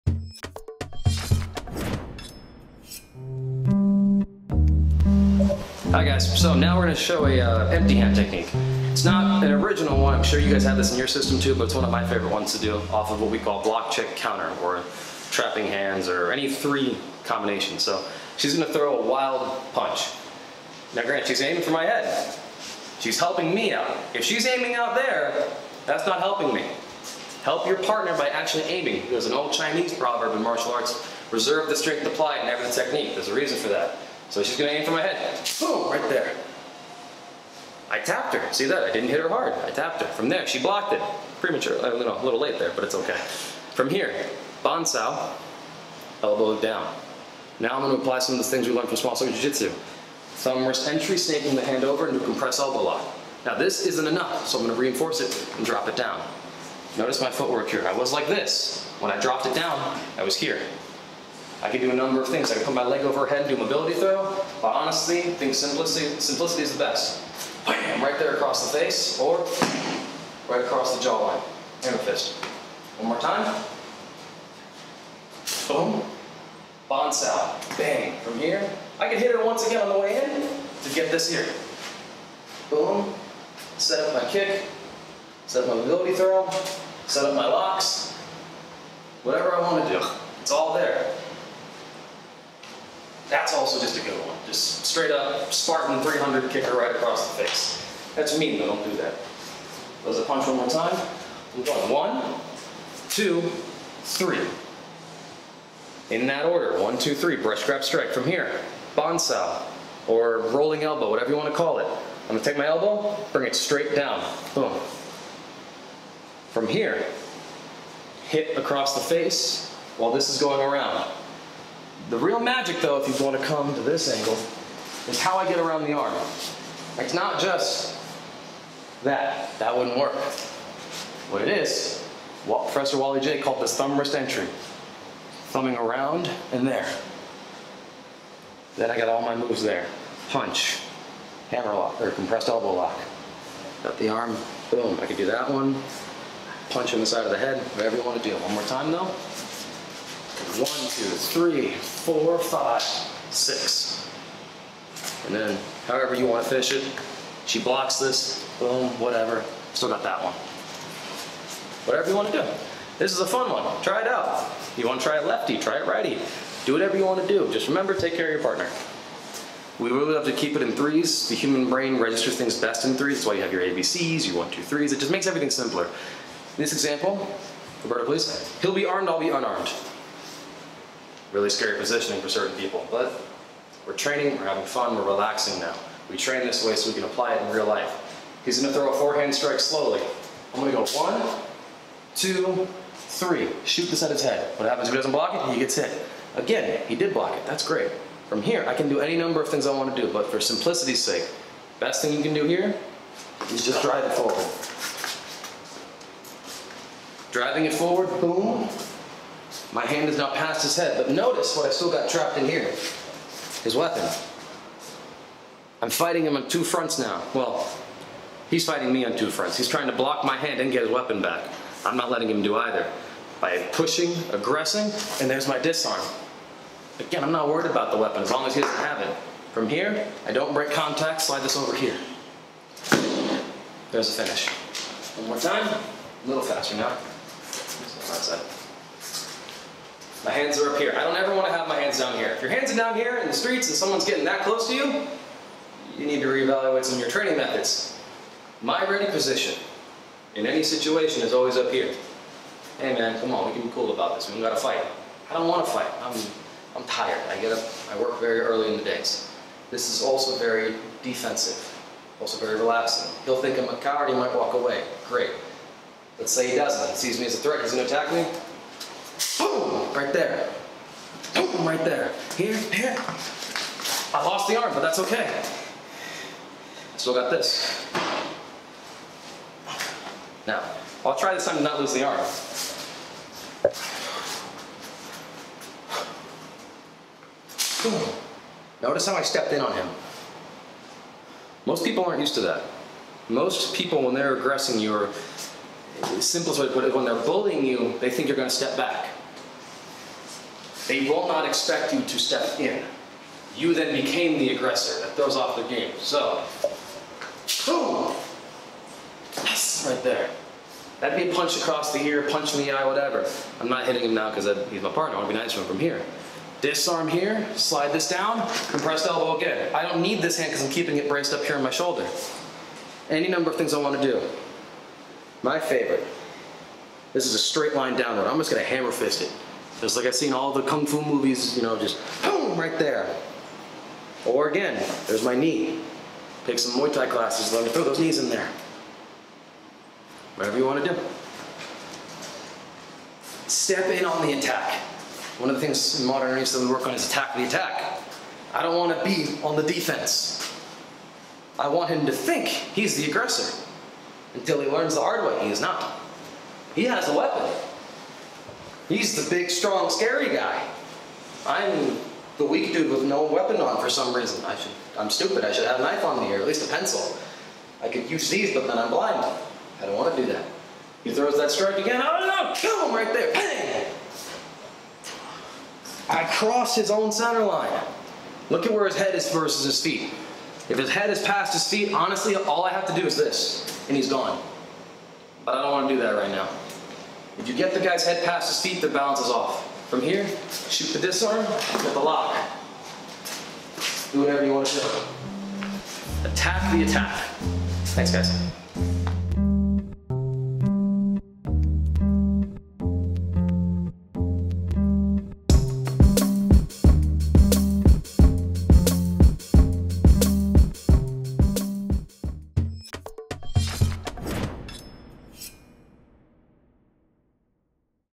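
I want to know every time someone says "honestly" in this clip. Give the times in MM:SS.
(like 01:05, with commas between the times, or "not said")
01:04, 06:21.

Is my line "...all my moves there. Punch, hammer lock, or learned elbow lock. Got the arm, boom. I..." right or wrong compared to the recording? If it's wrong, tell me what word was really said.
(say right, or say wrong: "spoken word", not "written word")
wrong: "compressed", not "learned".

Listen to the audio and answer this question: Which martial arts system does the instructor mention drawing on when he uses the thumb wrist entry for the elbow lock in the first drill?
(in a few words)
Small circle jiu-jitsu.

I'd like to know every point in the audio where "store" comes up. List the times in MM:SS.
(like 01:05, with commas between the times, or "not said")
not said.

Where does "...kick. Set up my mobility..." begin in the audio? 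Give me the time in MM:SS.
01:24.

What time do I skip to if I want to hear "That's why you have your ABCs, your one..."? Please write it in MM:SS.
02:53.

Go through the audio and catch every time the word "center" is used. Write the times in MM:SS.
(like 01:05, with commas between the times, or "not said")
06:17.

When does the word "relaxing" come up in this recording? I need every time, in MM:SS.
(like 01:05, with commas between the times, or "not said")
03:05, 04:22.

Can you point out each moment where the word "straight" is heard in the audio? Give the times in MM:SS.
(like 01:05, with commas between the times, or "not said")
01:34, 01:53, 05:27.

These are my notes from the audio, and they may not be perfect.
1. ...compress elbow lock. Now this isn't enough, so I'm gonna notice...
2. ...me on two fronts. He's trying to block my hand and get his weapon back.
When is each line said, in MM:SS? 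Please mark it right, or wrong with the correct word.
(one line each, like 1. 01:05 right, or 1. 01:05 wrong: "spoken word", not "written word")
1. 00:52 wrong: "reinforce", not "notice"
2. 03:38 right.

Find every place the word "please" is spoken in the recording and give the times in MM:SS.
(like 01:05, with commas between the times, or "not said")
02:58.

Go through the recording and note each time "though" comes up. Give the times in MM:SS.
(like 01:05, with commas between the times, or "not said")
02:02, 02:28.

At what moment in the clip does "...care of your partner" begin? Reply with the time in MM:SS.
02:48.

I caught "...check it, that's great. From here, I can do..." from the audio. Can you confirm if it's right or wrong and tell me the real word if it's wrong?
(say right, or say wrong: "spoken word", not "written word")
wrong: "block", not "check".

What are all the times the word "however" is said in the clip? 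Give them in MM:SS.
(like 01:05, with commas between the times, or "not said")
02:35.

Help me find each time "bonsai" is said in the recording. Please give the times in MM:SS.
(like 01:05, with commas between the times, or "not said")
00:44, 01:48.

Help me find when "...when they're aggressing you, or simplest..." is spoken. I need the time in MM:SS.
04:54.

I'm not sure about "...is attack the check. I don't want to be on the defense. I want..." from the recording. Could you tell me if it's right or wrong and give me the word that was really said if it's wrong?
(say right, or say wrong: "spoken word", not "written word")
wrong: "attack", not "check".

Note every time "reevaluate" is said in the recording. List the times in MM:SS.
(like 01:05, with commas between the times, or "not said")
04:06.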